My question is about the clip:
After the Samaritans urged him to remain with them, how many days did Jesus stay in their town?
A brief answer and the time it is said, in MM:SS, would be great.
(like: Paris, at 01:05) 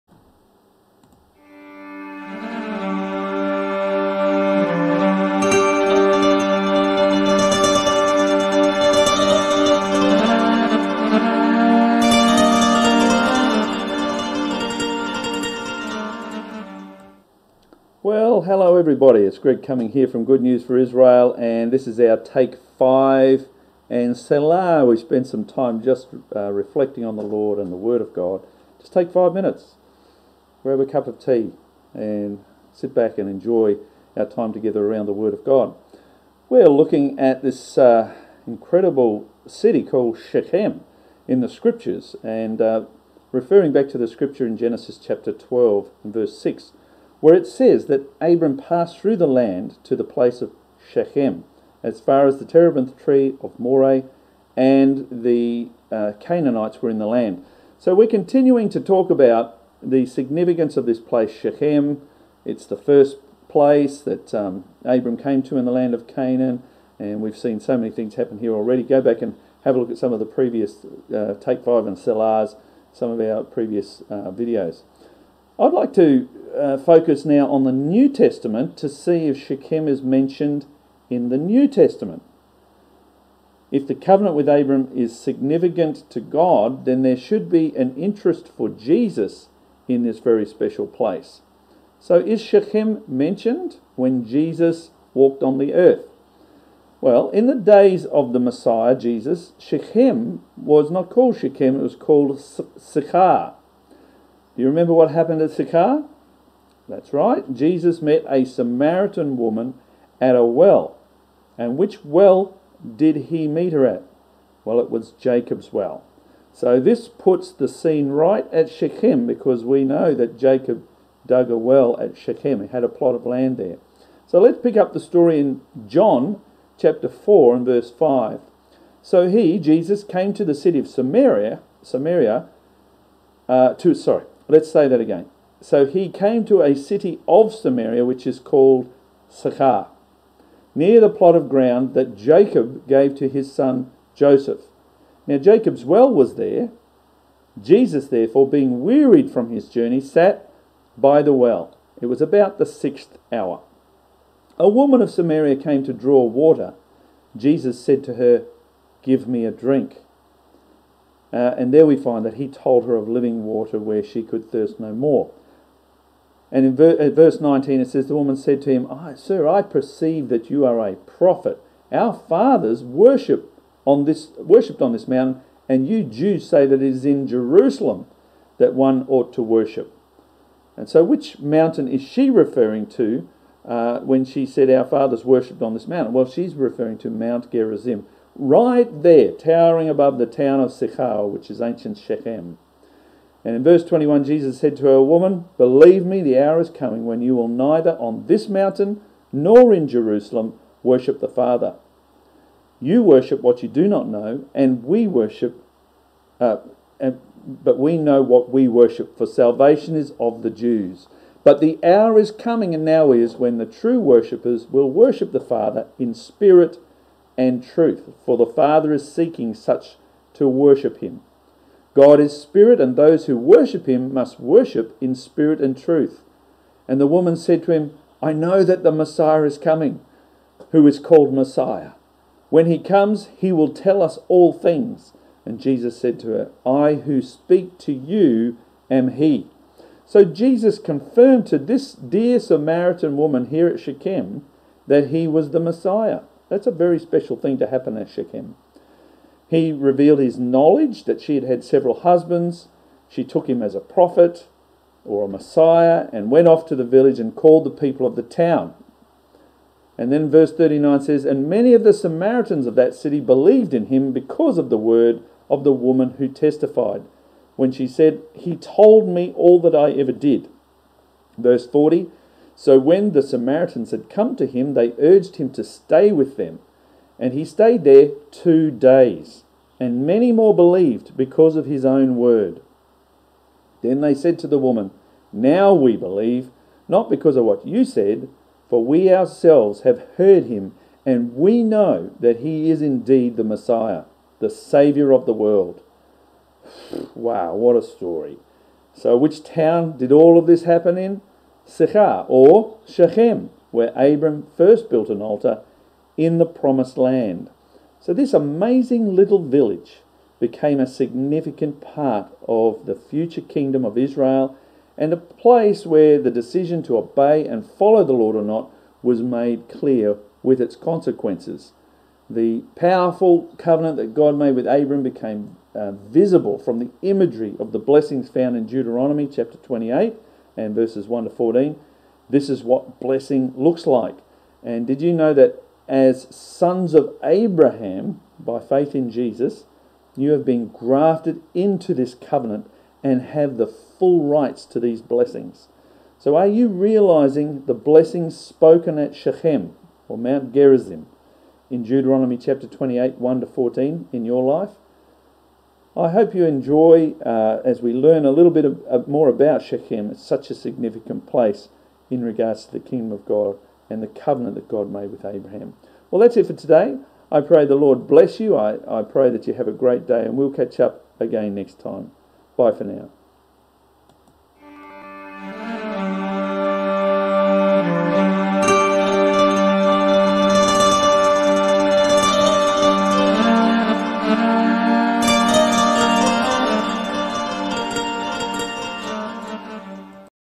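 2 days, at 04:38.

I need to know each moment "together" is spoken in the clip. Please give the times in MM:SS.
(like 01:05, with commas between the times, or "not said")
00:34.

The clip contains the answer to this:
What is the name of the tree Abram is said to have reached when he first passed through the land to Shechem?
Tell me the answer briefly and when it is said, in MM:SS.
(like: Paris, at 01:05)
terebinth tree of Moreh, at 00:52.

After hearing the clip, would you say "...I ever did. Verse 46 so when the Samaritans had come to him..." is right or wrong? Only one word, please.
wrong.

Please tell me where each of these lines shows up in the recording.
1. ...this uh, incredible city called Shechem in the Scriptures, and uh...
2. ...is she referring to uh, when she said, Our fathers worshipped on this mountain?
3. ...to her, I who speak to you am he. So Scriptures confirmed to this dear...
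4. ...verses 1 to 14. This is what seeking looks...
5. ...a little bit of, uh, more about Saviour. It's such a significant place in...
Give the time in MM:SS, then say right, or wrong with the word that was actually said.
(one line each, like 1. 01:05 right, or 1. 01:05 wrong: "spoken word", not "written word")
1. 00:37 right
2. 03:01 right
3. 03:56 wrong: "Jesus", not "Scriptures"
4. 05:30 wrong: "blessing", not "seeking"
5. 05:58 wrong: "Shechem", not "Saviour".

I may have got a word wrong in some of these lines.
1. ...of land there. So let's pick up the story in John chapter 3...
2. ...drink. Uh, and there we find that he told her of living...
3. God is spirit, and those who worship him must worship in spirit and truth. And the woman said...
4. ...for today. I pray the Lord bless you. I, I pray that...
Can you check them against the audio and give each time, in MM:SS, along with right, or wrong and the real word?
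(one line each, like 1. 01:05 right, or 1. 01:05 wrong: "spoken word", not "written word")
1. 02:03 wrong: "4", not "3"
2. 02:39 right
3. 03:41 right
4. 06:06 right.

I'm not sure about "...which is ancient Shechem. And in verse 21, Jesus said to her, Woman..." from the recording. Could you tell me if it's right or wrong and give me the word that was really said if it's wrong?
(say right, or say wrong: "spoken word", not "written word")
right.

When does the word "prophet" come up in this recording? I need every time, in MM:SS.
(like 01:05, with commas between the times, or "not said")
02:50, 04:13.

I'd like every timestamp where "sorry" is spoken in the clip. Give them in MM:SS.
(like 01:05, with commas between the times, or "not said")
02:13.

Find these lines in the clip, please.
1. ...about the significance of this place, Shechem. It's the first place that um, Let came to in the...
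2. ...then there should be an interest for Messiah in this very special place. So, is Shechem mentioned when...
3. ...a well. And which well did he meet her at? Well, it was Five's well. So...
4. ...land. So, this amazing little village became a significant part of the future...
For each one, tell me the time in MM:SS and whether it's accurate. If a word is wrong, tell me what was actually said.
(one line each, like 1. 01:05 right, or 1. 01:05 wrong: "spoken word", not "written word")
1. 00:59 wrong: "Abram", not "Let"
2. 01:26 wrong: "Jesus", not "Messiah"
3. 01:50 wrong: "Jacob", not "Five"
4. 05:06 right.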